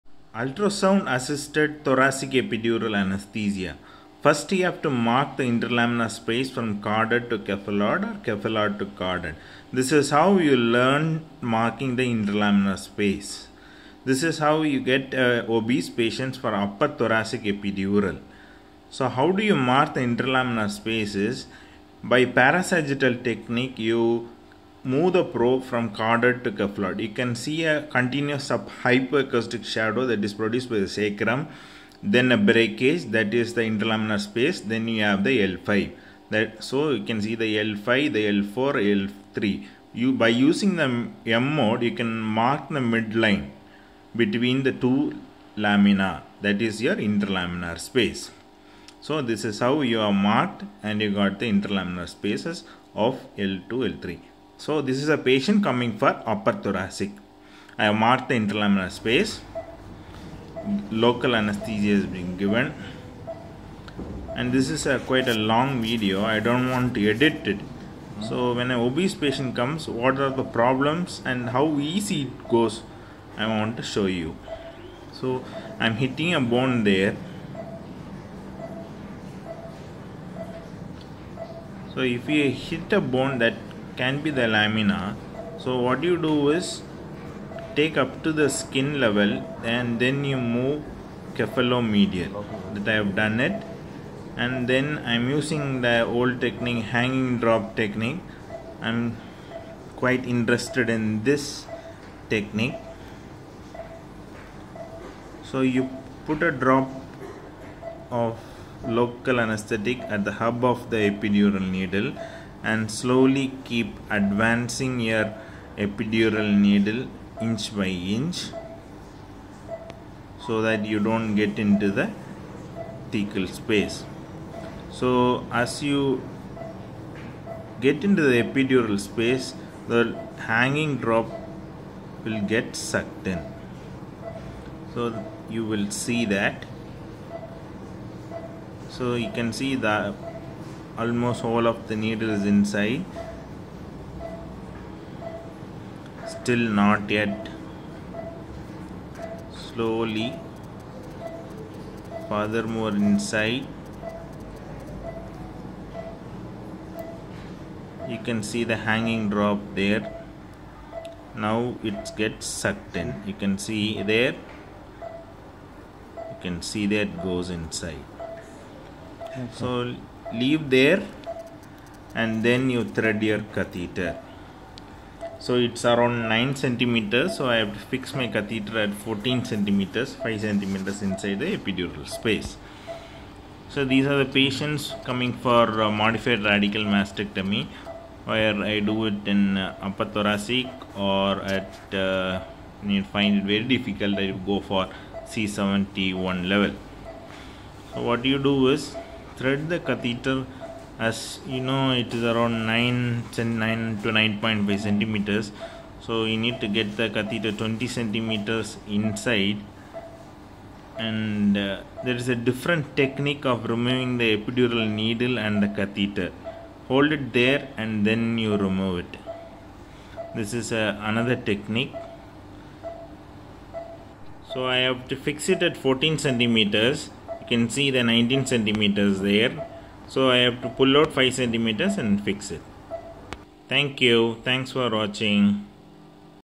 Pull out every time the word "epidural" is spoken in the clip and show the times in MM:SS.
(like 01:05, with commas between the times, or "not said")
00:02, 00:17, 01:50, 01:55, 02:08, 03:01, 03:34.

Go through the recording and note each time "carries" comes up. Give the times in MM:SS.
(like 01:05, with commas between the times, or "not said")
not said.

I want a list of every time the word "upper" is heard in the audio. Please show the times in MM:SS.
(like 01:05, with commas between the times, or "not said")
00:16, 00:56, 03:09.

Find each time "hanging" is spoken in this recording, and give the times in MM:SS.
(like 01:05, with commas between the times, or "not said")
01:36, 02:10, 02:38.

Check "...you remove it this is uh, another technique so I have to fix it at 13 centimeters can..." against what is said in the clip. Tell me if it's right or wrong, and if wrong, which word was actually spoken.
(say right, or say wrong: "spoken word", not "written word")
wrong: "14", not "13".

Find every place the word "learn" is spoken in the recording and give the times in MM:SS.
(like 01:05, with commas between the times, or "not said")
00:10.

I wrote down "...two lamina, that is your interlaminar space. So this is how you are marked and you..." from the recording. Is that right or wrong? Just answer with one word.
right.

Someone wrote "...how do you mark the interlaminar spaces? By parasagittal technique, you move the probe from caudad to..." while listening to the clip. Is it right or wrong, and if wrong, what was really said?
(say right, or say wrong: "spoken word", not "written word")
right.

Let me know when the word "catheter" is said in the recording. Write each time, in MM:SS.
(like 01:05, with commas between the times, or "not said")
02:53, 02:58, 03:19, 03:27, 03:35.